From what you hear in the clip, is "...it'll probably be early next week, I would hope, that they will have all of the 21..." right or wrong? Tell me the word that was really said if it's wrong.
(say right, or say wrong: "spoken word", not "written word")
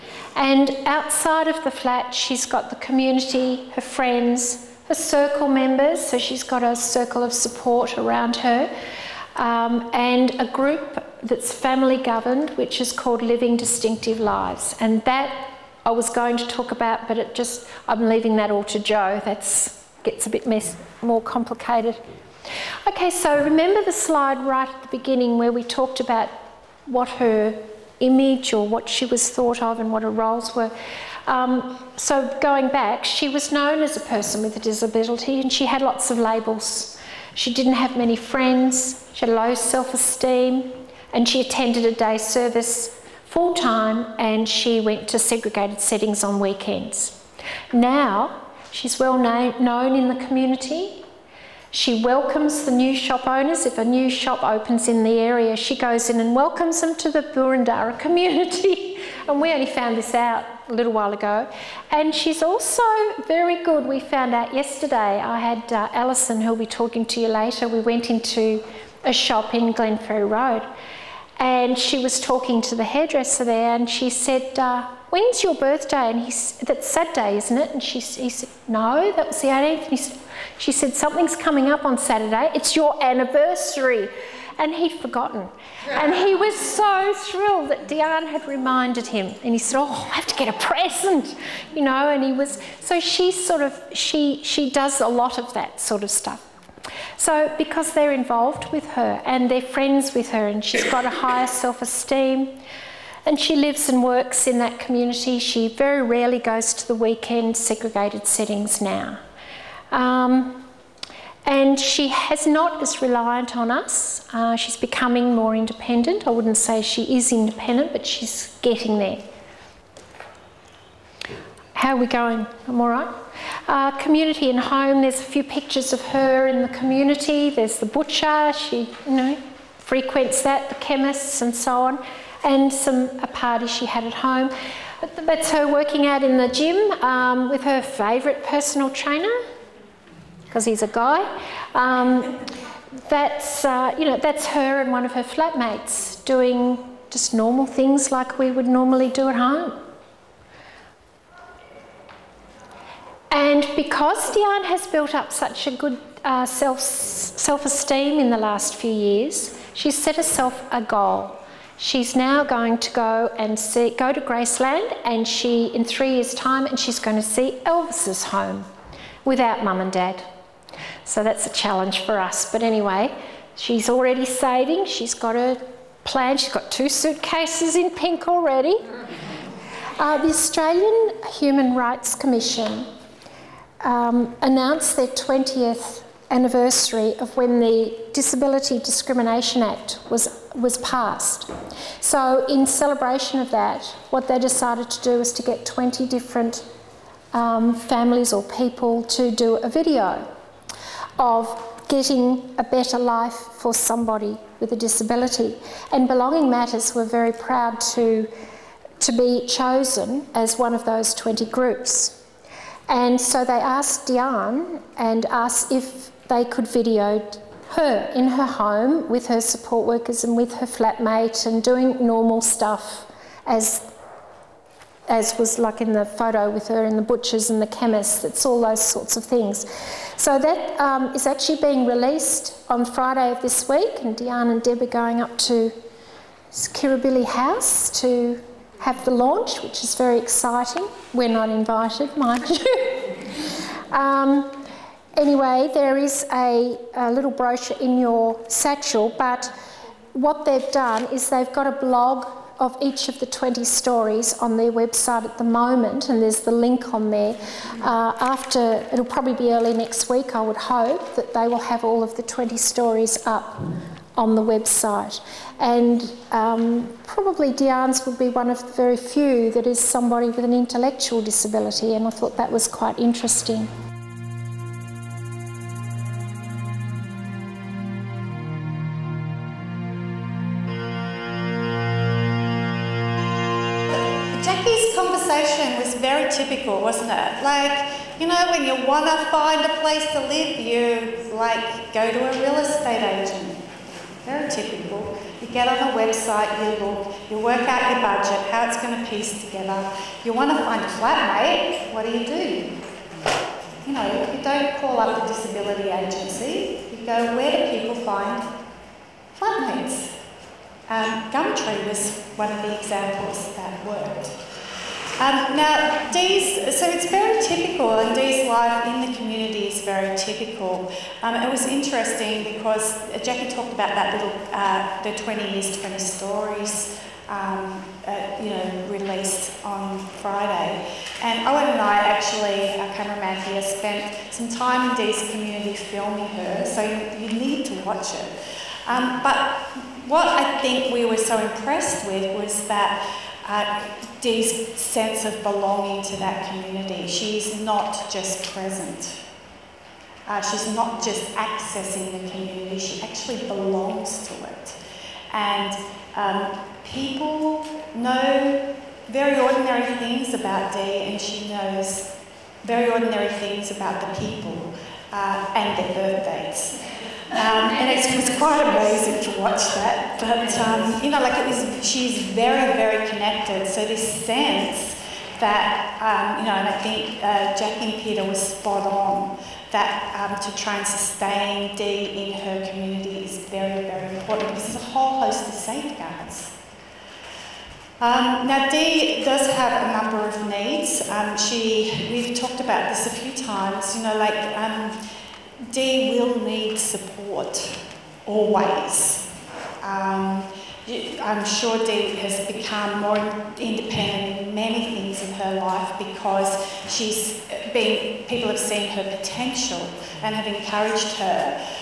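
wrong: "20", not "21".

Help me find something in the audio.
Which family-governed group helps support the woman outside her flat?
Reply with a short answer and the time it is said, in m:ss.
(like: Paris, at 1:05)
Living Distinctive Lives, at 0:13.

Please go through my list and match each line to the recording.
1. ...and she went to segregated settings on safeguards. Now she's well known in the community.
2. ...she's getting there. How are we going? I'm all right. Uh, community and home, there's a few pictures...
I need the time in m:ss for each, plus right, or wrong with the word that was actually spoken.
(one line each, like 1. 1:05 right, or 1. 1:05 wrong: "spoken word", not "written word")
1. 0:44 wrong: "weekends", not "safeguards"
2. 1:58 right.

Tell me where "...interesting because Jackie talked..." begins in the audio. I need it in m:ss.
5:21.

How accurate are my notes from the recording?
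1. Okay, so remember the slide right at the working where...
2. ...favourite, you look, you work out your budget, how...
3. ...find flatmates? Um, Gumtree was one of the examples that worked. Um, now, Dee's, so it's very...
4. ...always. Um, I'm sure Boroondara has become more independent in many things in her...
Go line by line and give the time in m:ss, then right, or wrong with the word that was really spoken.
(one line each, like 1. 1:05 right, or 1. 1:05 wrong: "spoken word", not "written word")
1. 0:22 wrong: "beginning", not "working"
2. 4:56 wrong: "website", not "favourite"
3. 5:07 right
4. 6:38 wrong: "Dee", not "Boroondara".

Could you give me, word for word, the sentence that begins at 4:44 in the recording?
Jackie's conversation was very typical, wasn't it?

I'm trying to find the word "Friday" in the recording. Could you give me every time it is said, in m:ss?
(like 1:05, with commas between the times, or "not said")
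3:52, 5:30.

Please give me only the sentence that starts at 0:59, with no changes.
and we only found this out a little while ago.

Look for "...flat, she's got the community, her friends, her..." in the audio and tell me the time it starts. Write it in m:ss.
0:01.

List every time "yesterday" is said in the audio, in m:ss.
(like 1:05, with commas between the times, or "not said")
1:04.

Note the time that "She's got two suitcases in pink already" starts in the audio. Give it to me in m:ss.
2:56.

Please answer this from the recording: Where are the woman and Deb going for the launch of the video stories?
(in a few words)
Kirribilli House.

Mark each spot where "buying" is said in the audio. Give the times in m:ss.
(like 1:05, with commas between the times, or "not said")
not said.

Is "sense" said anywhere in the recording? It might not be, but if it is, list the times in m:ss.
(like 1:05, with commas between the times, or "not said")
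5:44, 6:14.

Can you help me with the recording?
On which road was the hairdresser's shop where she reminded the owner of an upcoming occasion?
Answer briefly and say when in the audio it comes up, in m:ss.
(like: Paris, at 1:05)
Glenferrie Road, at 1:09.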